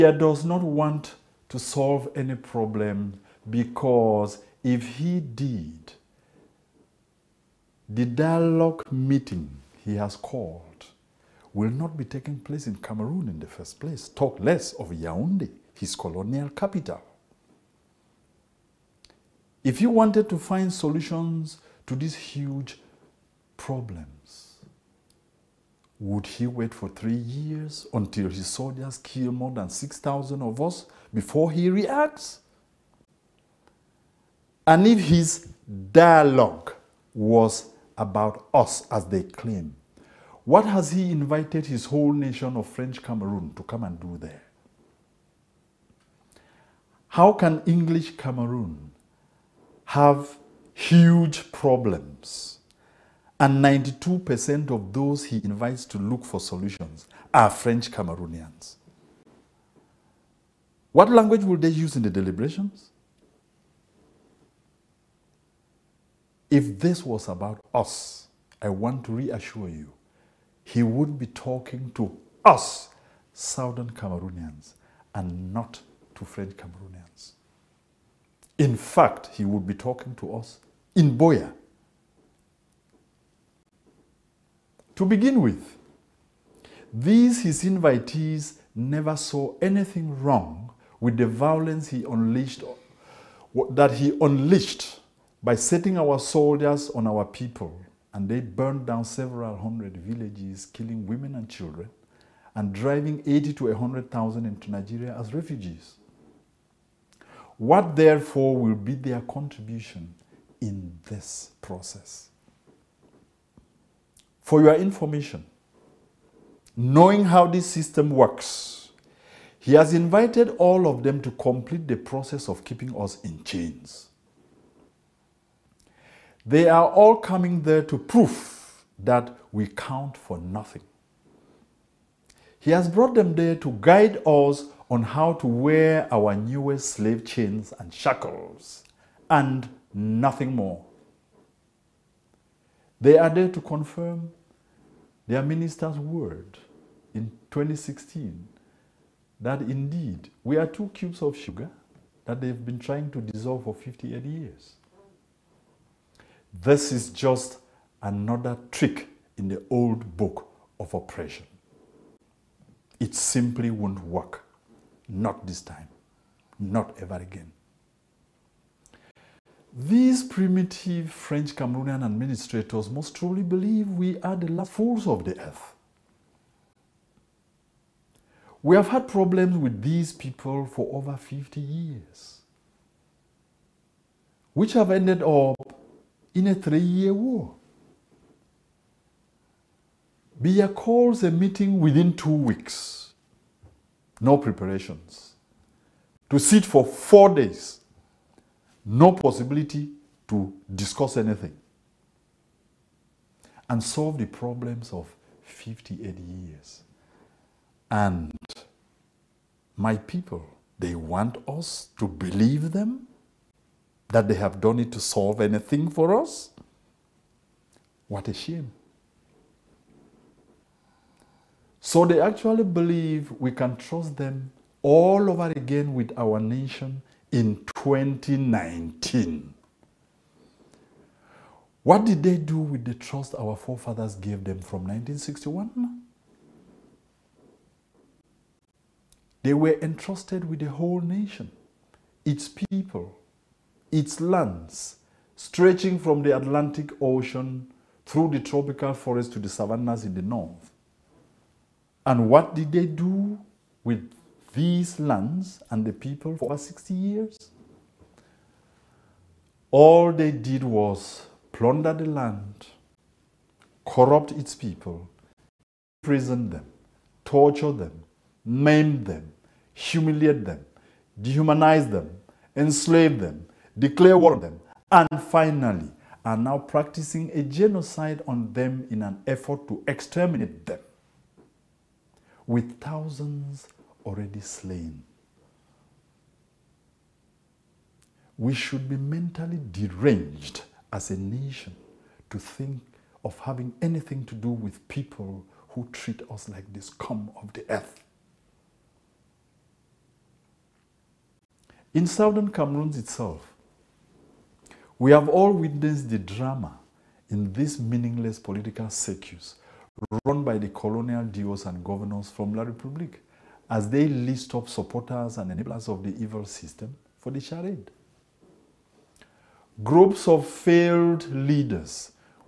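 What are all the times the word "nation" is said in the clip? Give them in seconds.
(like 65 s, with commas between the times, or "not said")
42 s, 226 s, 241 s, 291 s.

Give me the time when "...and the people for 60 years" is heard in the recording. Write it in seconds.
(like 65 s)
255 s.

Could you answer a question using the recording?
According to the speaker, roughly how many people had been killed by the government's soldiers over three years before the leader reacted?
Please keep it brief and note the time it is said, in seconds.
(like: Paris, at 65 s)
6,000, at 29 s.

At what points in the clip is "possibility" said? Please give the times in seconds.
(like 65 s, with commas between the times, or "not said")
199 s.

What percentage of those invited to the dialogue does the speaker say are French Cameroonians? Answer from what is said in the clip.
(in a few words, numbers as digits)
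92%.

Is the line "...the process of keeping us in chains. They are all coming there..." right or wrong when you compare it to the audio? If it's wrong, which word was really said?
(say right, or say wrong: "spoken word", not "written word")
right.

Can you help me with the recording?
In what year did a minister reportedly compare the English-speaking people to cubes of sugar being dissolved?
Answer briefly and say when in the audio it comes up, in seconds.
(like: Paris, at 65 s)
2016, at 147 s.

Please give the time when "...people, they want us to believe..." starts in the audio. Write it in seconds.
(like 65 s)
209 s.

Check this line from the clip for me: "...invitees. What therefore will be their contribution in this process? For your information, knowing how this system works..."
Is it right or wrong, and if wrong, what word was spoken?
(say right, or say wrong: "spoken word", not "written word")
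wrong: "refugees", not "invitees".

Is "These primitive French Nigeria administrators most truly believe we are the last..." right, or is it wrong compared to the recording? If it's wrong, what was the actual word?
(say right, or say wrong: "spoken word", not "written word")
wrong: "Cameroonian", not "Nigeria".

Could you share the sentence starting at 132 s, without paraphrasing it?
He has brought them there to guide us on how to wear our newest slave chains and shackles and nothing more.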